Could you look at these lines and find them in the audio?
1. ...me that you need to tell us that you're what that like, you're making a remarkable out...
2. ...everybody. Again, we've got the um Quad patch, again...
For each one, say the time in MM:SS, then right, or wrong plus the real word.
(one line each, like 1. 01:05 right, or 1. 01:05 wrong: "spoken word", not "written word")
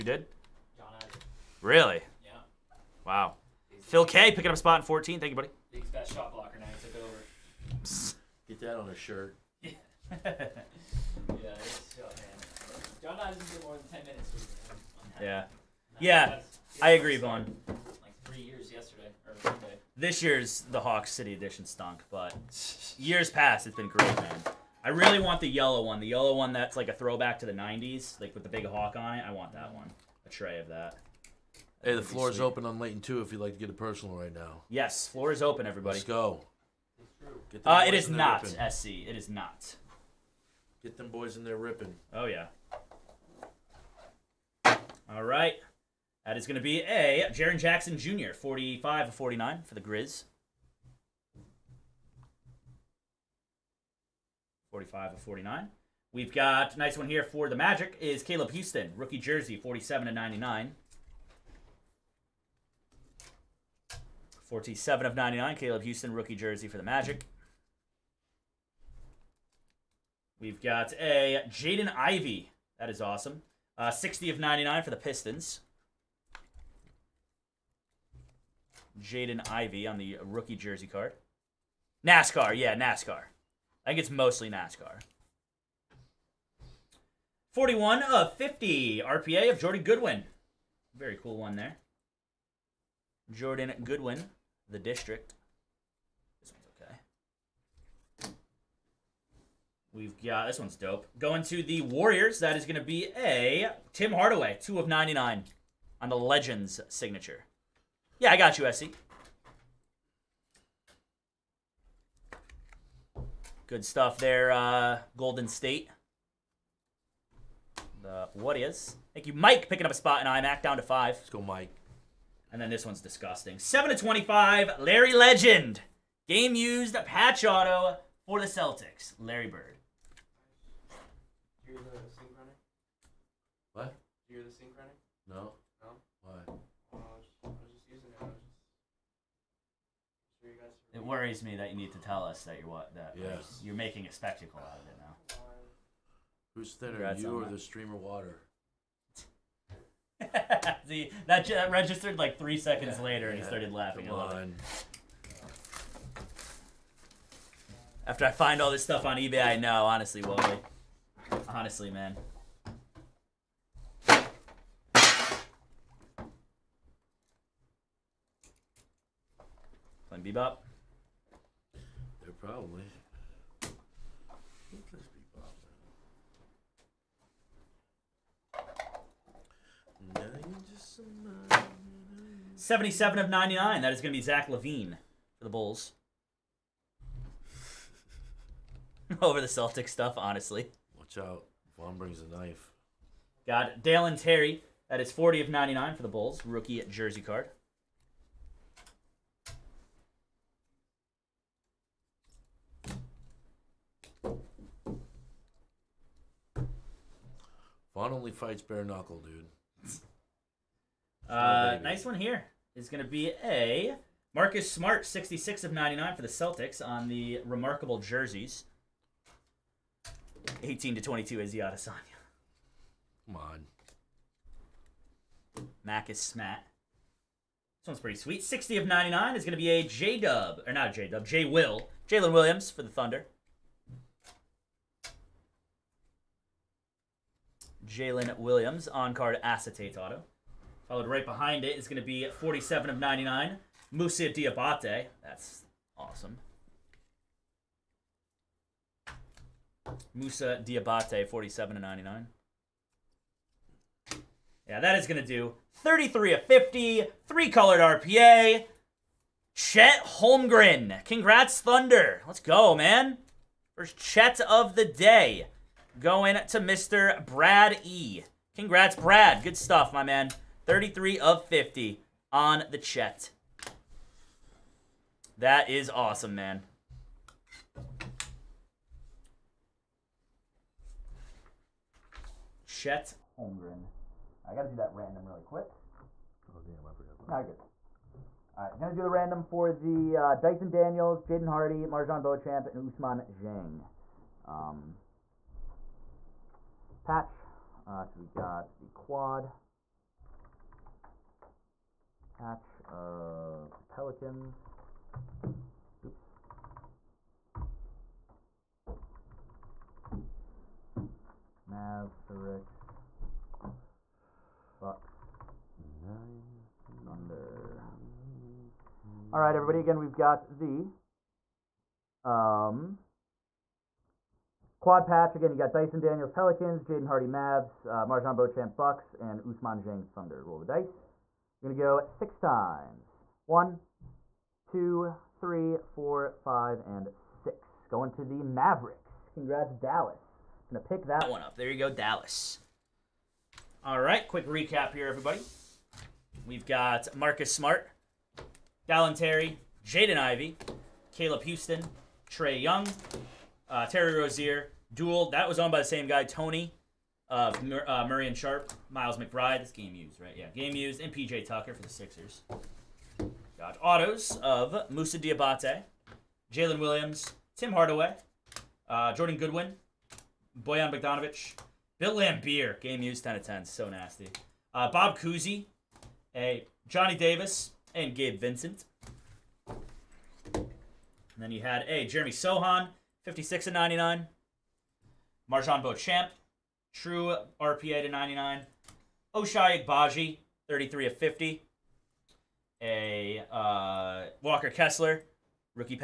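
1. 02:21 wrong: "spectacle", not "remarkable"
2. 05:19 right.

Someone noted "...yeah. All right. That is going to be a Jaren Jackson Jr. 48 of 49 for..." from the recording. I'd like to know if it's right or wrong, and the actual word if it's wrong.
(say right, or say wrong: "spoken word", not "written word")
wrong: "45", not "48".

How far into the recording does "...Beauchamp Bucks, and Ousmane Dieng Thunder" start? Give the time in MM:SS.
05:28.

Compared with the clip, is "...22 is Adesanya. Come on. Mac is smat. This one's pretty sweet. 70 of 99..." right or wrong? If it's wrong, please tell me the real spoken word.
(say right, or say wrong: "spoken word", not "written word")
wrong: "60", not "70".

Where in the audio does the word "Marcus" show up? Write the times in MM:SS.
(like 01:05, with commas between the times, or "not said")
03:34, 05:47.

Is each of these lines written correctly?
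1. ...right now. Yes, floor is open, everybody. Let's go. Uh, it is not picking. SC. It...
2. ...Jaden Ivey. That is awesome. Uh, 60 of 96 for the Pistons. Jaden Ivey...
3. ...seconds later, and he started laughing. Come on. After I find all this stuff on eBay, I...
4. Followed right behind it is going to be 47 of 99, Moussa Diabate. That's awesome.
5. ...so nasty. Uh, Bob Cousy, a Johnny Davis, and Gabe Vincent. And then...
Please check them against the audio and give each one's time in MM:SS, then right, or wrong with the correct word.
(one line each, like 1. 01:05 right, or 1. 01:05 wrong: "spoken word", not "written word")
1. 00:34 wrong: "ripping", not "picking"
2. 01:11 wrong: "99", not "96"
3. 02:32 right
4. 04:00 right
5. 06:13 right.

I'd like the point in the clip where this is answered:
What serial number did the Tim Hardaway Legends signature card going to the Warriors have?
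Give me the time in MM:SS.
01:44.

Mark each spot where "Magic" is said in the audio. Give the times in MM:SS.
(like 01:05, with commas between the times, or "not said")
00:57, 01:06.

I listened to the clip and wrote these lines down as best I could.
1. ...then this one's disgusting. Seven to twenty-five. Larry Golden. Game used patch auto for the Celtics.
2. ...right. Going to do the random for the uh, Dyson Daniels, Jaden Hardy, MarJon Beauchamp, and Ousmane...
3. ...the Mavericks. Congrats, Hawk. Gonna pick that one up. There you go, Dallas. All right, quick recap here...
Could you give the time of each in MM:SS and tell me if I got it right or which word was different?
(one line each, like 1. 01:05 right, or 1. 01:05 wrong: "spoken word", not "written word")
1. 02:02 wrong: "Legend", not "Golden"
2. 04:48 right
3. 05:38 wrong: "Dallas", not "Hawk".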